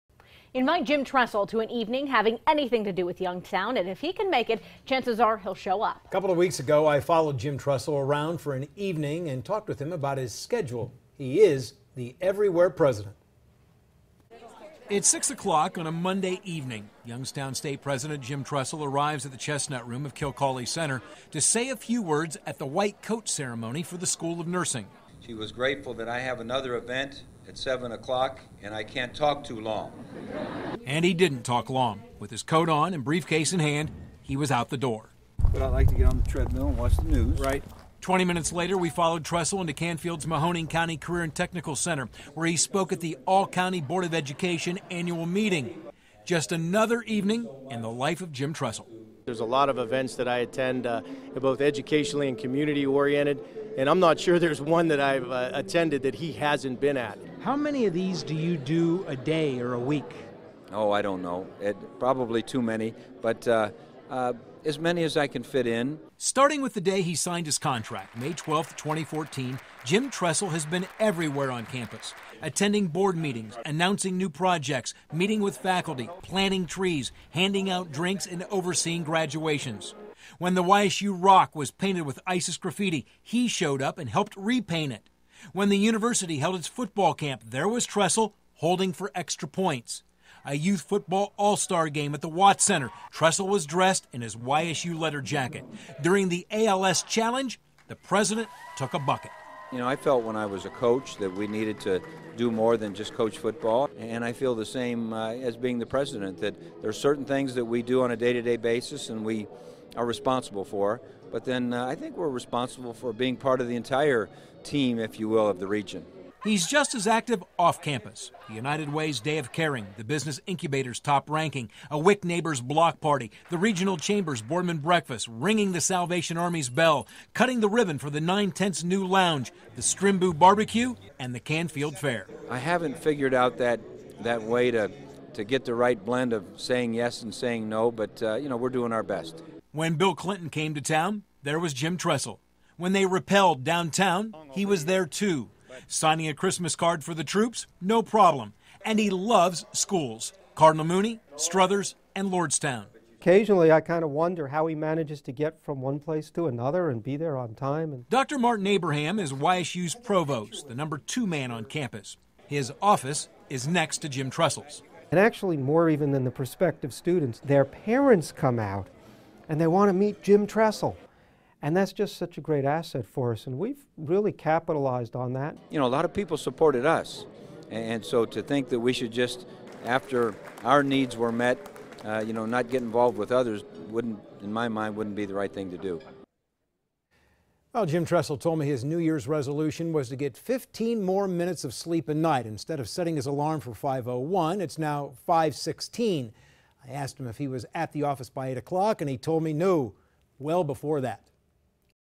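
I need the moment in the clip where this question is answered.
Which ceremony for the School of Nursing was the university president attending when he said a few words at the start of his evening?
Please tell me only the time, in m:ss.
0:22.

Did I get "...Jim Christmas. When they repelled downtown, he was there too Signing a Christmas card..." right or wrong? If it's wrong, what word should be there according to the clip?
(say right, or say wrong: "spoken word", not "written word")
wrong: "Tressel", not "Christmas".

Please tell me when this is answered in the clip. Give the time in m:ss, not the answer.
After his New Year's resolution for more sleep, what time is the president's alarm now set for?
3:15.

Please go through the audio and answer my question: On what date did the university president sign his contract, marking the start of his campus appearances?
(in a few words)
May 12, 2014.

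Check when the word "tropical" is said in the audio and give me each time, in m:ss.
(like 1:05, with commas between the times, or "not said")
not said.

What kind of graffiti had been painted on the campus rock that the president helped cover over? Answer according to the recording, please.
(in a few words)
ISIS.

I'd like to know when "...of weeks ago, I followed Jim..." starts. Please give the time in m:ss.
0:06.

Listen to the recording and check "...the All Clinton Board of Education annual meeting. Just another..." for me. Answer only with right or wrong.
wrong.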